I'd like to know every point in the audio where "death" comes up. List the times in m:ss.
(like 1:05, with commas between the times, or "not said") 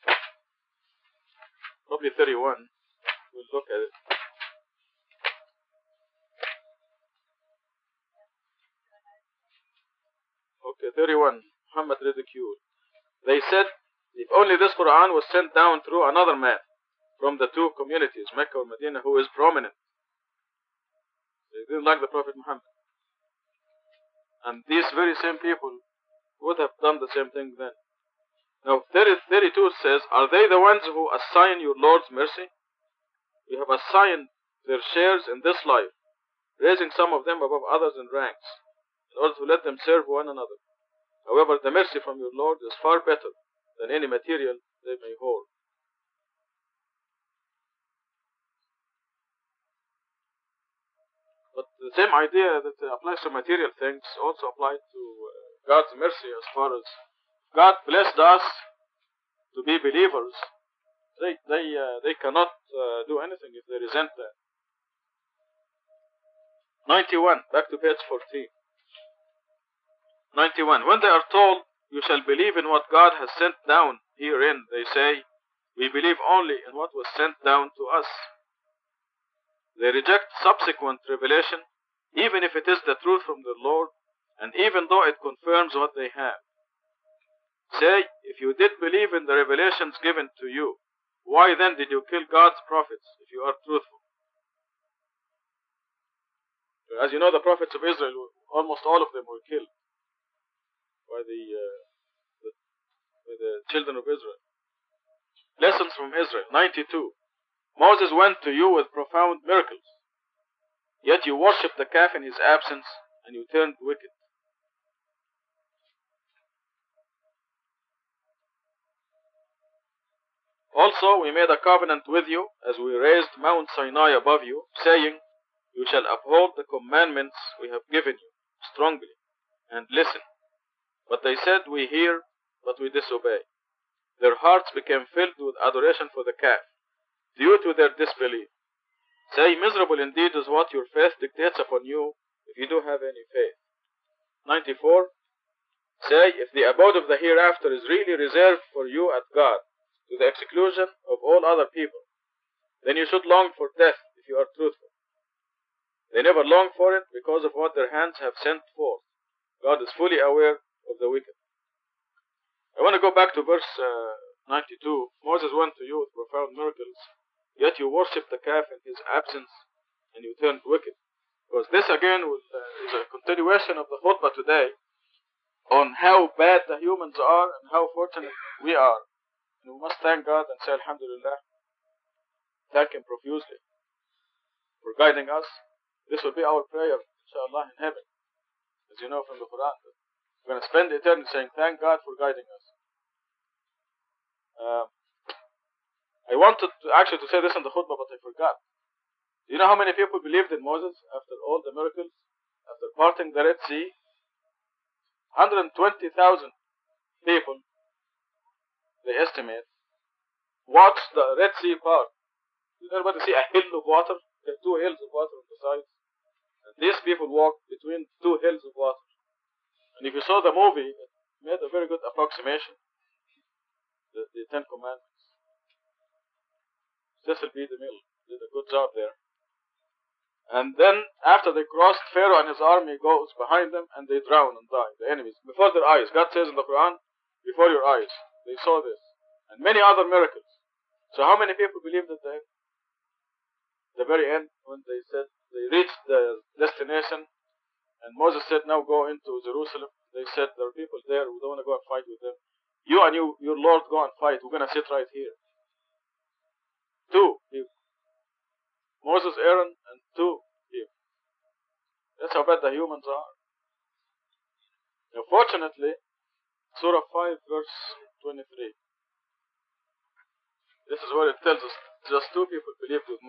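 2:33.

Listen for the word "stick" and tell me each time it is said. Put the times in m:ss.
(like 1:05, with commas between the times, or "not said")
not said.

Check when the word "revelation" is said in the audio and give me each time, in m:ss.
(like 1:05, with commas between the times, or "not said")
1:21, 1:29.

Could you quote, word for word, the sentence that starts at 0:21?
They didn't like the Prophet Muhammad.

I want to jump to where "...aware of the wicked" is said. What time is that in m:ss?
2:40.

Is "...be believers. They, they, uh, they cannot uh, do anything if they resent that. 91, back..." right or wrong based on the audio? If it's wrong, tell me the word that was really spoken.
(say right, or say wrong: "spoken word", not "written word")
right.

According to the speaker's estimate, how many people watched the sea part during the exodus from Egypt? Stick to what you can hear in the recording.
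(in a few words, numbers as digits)
120,000.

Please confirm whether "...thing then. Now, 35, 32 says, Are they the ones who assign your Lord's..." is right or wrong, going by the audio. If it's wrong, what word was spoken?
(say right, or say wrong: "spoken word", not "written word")
wrong: "30", not "35".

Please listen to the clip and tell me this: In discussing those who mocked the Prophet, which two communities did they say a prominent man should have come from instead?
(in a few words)
Mecca or Medina.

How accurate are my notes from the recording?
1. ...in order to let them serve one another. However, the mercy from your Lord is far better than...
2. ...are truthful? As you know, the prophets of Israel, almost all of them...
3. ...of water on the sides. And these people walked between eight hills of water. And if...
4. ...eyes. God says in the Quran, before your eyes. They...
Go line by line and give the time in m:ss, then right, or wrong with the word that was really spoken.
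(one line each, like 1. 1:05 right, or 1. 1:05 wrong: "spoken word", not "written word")
1. 0:39 right
2. 1:33 right
3. 3:35 wrong: "two", not "eight"
4. 3:55 right.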